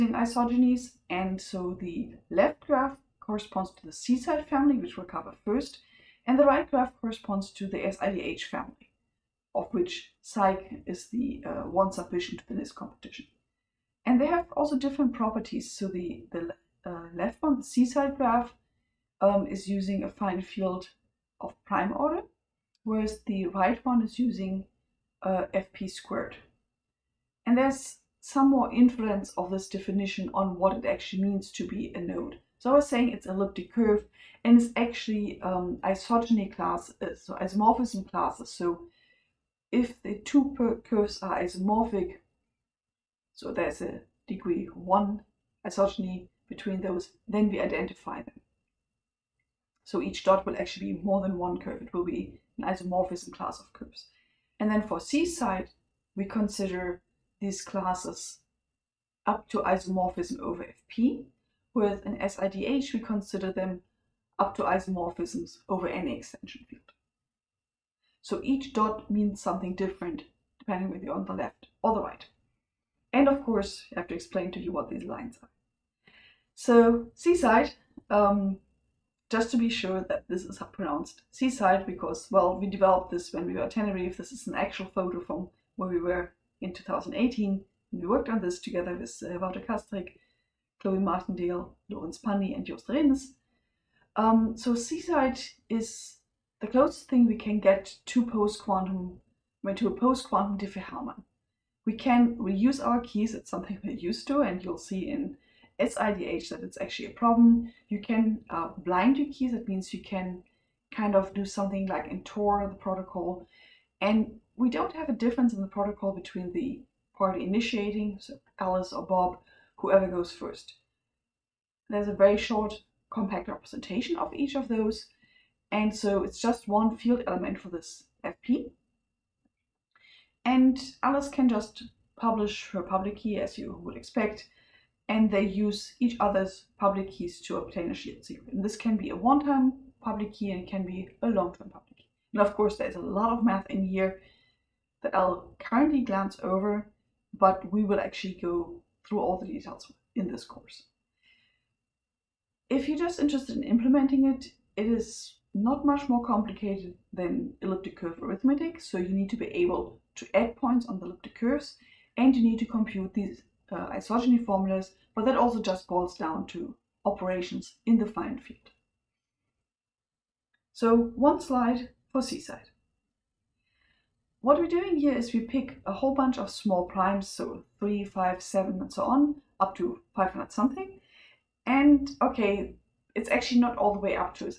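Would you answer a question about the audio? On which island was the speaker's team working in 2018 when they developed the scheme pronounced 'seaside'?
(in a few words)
Tenerife.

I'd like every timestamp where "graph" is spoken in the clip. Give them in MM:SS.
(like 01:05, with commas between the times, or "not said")
00:02, 00:06, 00:18.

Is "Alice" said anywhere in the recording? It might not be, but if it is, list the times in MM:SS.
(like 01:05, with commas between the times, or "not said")
01:58, 02:11.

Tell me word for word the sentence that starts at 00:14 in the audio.
And they have also different properties.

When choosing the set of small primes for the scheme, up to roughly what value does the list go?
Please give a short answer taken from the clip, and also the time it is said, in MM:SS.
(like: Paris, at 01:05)
500 something, at 03:00.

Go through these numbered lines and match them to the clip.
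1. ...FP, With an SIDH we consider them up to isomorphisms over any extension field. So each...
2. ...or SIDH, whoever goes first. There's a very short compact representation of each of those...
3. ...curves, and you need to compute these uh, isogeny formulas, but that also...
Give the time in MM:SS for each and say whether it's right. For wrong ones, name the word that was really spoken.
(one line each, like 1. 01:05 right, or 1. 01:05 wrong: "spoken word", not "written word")
1. 01:00 right
2. 01:58 wrong: "Bob", not "SIDH"
3. 02:41 right.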